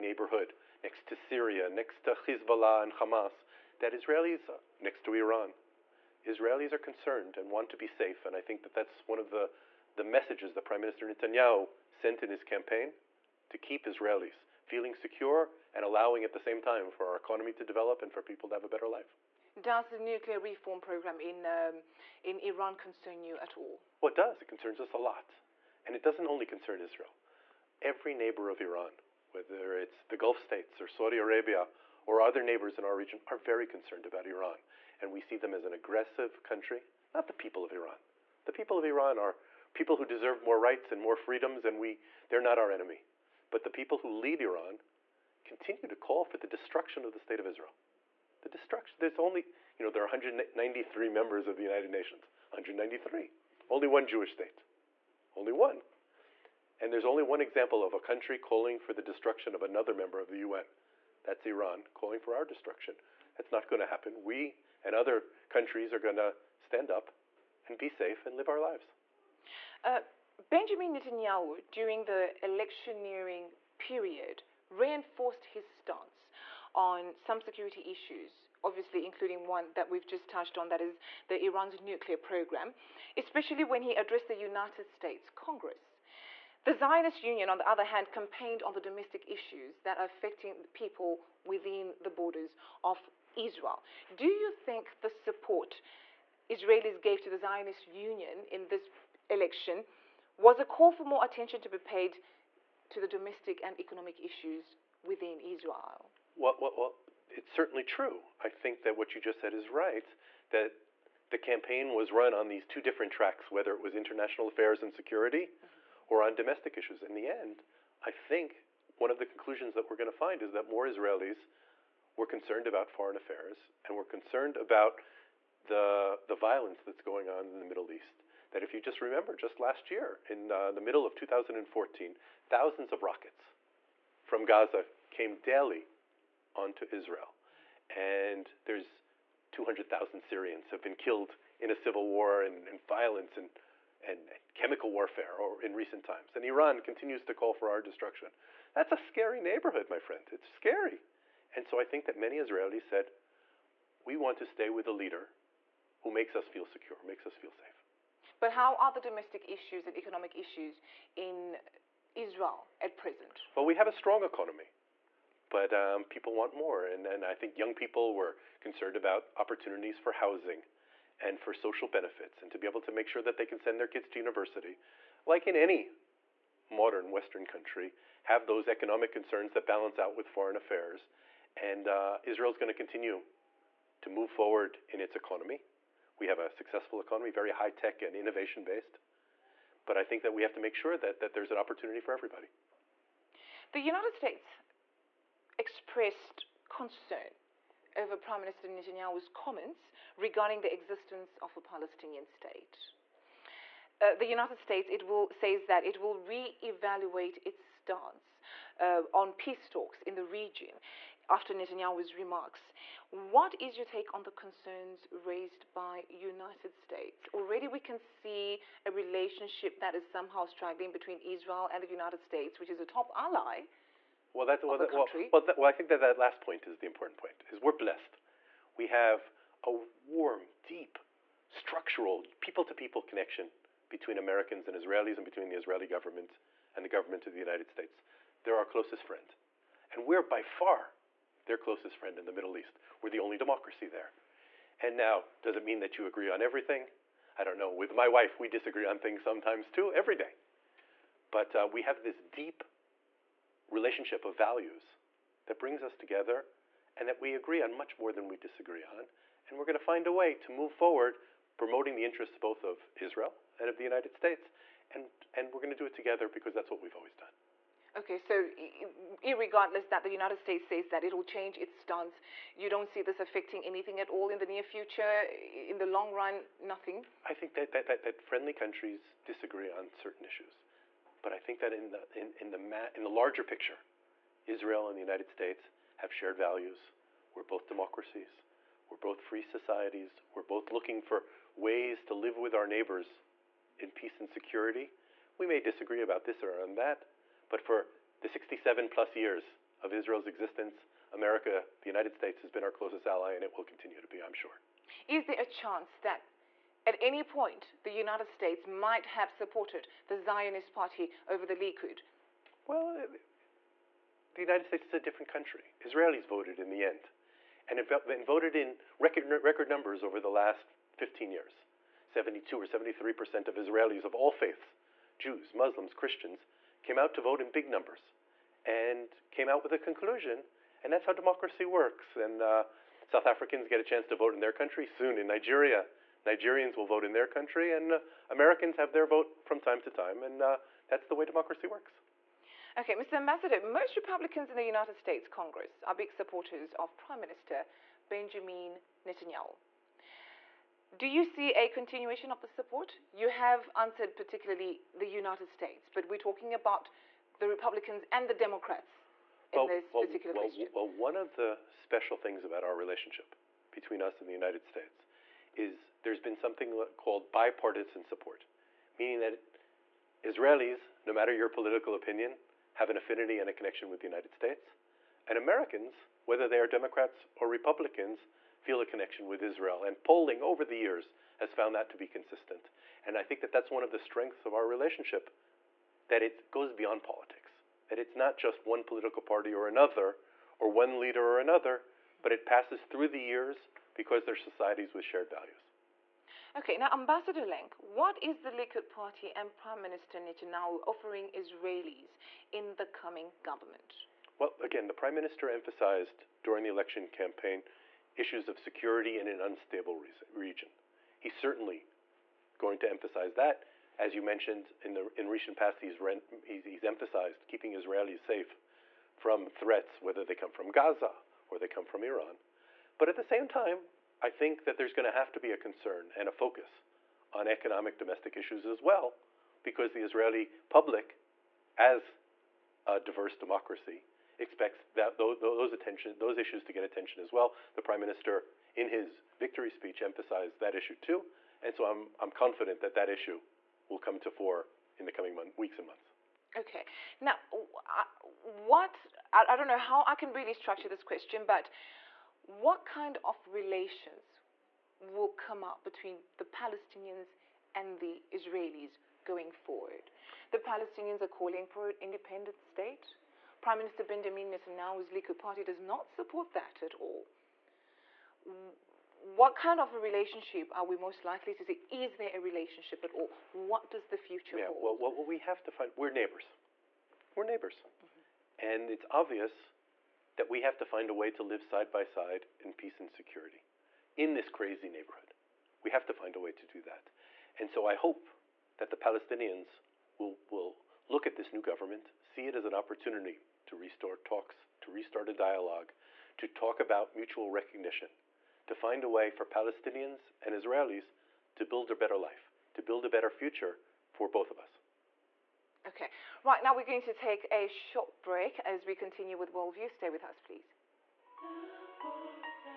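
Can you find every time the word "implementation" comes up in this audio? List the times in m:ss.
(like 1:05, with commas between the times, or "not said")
not said.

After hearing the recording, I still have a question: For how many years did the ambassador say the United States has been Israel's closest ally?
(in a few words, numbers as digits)
67.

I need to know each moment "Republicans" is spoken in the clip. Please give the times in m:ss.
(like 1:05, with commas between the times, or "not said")
5:43, 5:57, 6:17.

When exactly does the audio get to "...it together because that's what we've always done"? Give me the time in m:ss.
4:25.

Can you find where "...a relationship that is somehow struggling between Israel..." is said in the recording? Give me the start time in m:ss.
3:38.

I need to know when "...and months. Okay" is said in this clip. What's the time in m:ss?
7:25.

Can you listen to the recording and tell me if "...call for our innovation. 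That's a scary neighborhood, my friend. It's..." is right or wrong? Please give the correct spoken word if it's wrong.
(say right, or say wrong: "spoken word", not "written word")
wrong: "destruction", not "innovation".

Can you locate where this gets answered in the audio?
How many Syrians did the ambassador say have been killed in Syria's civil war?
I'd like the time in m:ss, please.
2:19.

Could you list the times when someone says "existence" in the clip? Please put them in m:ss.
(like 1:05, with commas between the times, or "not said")
3:20, 5:00.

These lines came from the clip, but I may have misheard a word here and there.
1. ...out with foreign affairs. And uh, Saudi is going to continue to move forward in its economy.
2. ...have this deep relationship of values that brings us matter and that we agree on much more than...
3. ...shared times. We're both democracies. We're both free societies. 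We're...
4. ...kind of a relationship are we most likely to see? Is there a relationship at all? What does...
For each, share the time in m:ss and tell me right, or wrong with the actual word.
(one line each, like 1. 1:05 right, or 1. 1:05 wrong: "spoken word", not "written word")
1. 2:59 wrong: "Israel", not "Saudi"
2. 4:11 wrong: "together", not "matter"
3. 4:46 wrong: "values", not "times"
4. 7:49 right.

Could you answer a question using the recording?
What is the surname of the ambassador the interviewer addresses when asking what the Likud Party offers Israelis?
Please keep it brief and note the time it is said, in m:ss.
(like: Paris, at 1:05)
Lenk, at 6:37.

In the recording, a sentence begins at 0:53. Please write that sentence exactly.
Only one Jewish state, only one.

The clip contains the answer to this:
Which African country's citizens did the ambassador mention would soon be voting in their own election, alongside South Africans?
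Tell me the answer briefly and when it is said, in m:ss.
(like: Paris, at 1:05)
Nigeria, at 5:35.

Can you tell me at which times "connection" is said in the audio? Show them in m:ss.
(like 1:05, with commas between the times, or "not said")
3:53, 6:13, 6:18.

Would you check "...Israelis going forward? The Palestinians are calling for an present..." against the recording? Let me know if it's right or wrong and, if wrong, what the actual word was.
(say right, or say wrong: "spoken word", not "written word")
wrong: "independent", not "present".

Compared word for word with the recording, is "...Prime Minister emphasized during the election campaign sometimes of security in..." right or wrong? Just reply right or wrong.
wrong.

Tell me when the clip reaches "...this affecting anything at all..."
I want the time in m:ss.
4:33.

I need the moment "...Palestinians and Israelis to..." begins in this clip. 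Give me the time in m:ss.
8:19.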